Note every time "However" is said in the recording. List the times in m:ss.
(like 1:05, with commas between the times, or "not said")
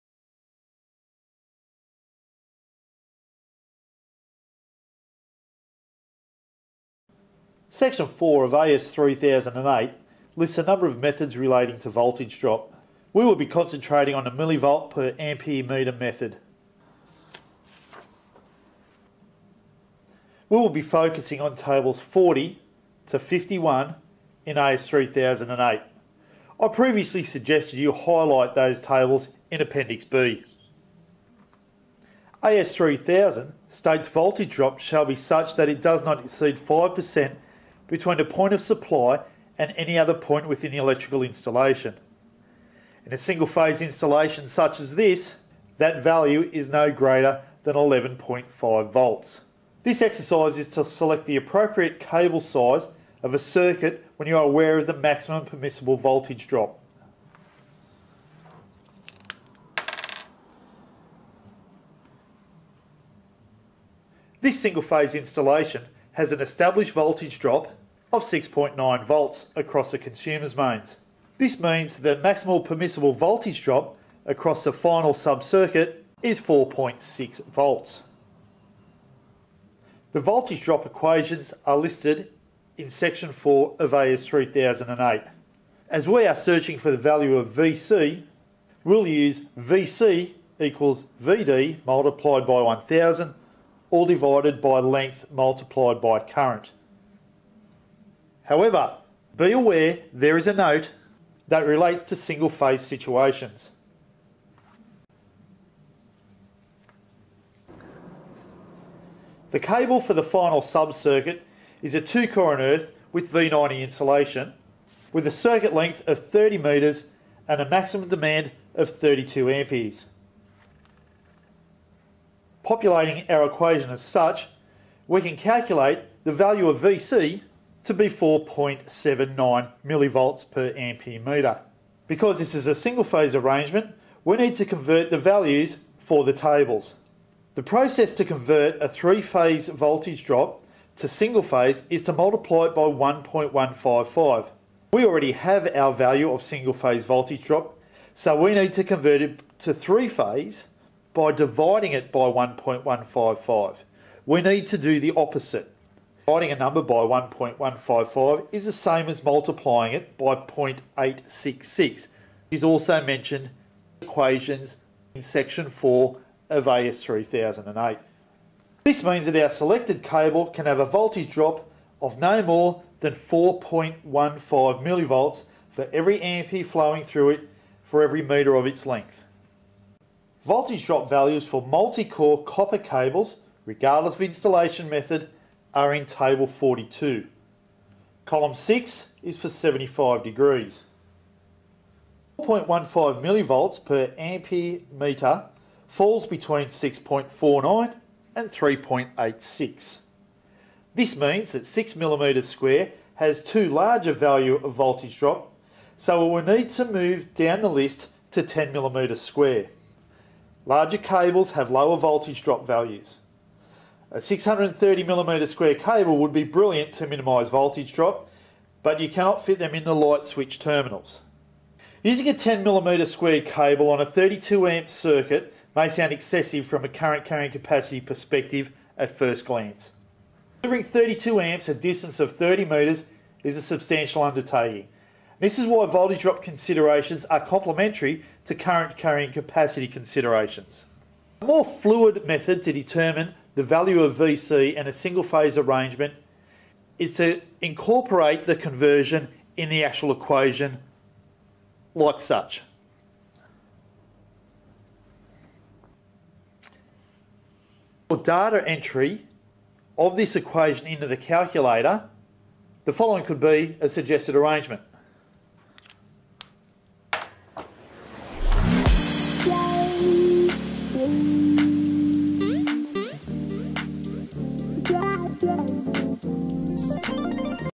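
1:38.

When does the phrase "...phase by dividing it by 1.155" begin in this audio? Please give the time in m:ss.
2:30.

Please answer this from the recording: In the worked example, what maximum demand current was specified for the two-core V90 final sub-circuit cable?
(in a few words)
32 amperes.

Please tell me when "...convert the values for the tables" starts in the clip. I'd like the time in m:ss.
2:14.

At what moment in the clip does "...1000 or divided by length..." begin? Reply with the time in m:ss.
1:32.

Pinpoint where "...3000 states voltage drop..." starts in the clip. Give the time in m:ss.
0:32.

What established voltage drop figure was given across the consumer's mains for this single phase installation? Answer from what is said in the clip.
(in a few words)
6.9 volts.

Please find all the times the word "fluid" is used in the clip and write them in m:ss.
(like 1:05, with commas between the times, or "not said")
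4:01.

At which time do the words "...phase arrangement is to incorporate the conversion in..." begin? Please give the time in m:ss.
4:05.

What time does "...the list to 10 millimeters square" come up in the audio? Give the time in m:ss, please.
3:27.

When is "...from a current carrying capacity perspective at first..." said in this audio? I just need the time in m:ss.
3:46.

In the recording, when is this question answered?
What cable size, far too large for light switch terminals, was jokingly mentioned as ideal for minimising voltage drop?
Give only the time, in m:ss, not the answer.
3:34.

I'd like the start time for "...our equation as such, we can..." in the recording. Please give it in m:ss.
2:03.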